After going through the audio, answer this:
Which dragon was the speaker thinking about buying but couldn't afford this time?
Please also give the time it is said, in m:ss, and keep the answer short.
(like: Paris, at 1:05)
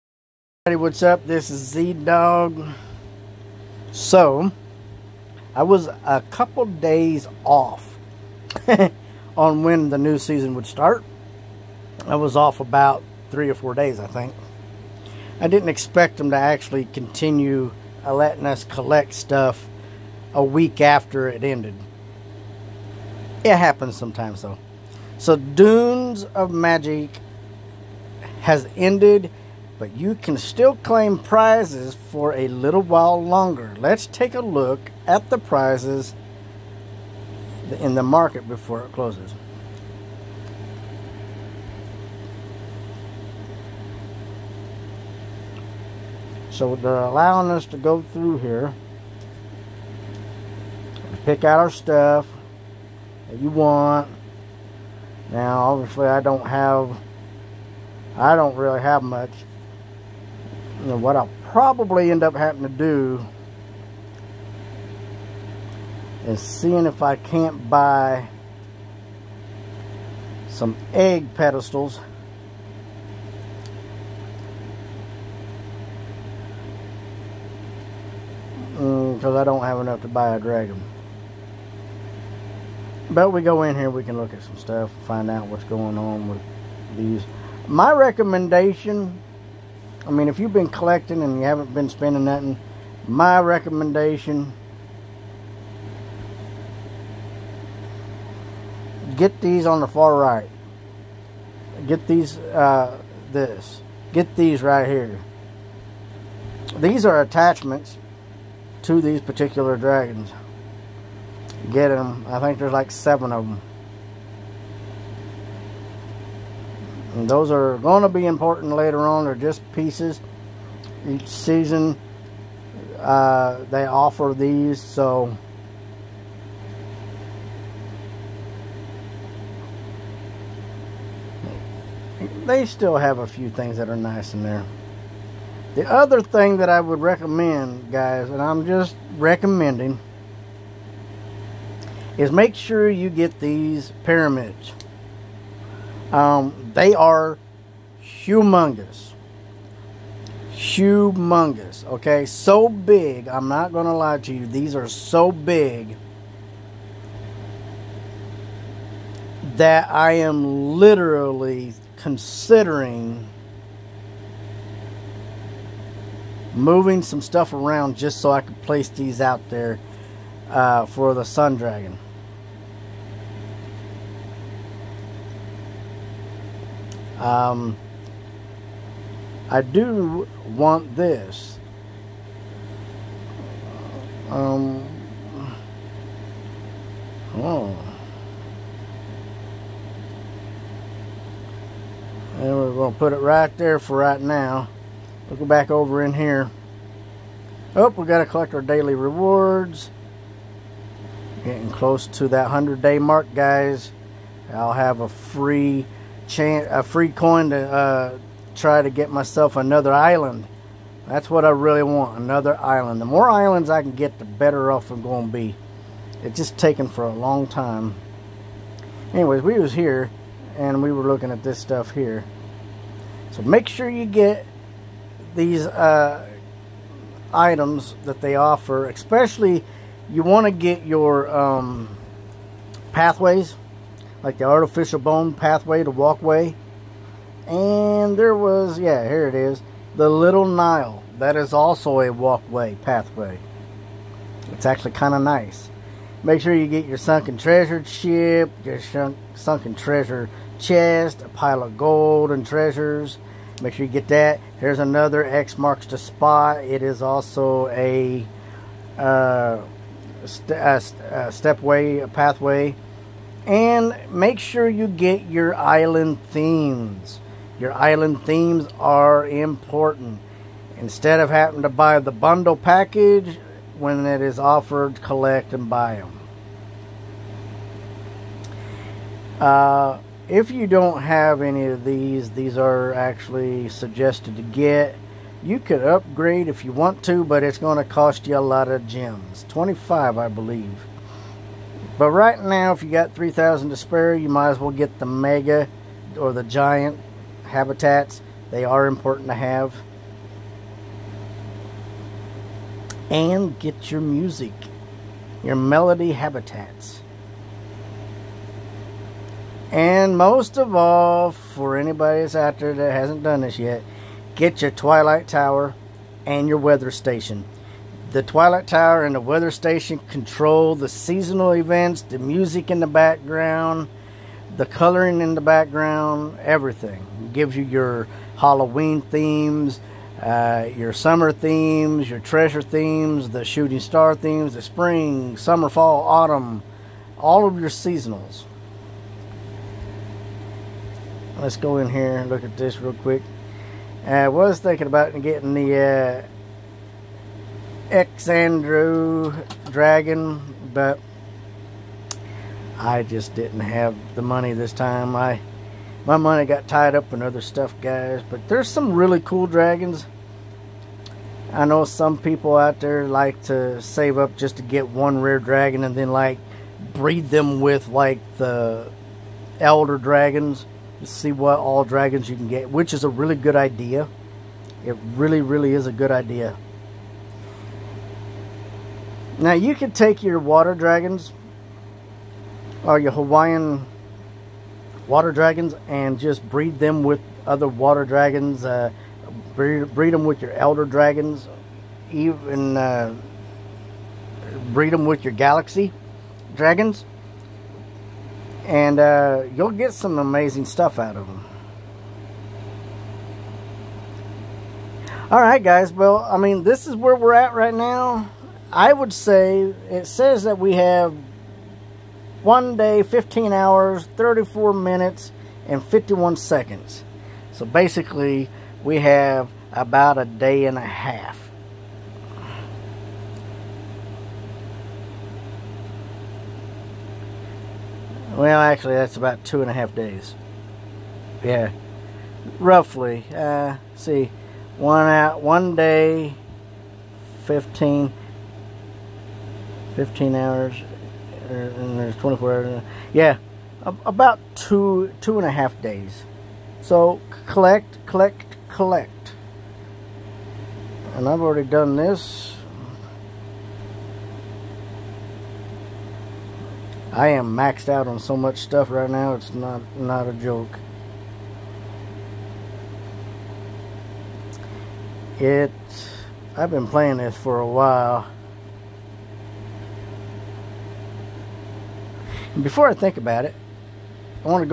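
Andrew Dragon, at 5:47.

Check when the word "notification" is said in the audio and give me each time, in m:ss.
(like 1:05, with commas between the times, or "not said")
not said.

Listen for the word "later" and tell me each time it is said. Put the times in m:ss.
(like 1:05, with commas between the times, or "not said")
1:58.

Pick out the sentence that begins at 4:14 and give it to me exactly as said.
Here's another X marks the spot.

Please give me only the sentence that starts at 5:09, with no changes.
And most of all, for anybody that's out there that hasn't done this yet, get your Twilight Tower and your weather station.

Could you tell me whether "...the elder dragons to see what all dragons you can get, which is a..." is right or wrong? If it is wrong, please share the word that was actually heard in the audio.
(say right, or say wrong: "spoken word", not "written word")
right.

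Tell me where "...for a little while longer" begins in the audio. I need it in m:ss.
0:32.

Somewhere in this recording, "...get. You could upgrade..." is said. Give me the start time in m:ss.
4:44.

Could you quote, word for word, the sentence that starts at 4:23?
And make sure you get your island themes.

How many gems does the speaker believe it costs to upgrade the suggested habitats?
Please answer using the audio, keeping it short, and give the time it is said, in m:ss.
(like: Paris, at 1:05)
25, at 4:49.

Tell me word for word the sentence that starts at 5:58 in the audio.
But there's some really cool dragons.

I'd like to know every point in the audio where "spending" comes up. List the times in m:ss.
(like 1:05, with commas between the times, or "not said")
1:31.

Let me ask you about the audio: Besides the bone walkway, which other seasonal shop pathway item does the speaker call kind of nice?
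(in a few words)
Little Nile.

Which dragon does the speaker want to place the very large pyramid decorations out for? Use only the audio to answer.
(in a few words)
Sun Dragon.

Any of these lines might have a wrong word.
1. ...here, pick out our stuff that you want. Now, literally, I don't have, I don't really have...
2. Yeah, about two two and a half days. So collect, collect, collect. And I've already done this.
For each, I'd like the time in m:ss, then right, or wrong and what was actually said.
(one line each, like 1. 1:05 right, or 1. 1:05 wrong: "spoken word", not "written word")
1. 0:48 wrong: "obviously", not "literally"
2. 7:23 right.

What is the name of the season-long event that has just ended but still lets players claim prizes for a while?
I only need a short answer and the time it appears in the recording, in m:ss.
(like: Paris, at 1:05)
Dunes of Magic, at 0:25.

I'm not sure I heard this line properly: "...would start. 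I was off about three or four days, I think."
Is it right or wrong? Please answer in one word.
right.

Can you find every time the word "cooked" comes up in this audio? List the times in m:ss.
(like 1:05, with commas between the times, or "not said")
not said.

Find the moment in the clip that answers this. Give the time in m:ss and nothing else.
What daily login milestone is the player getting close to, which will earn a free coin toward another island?
3:22.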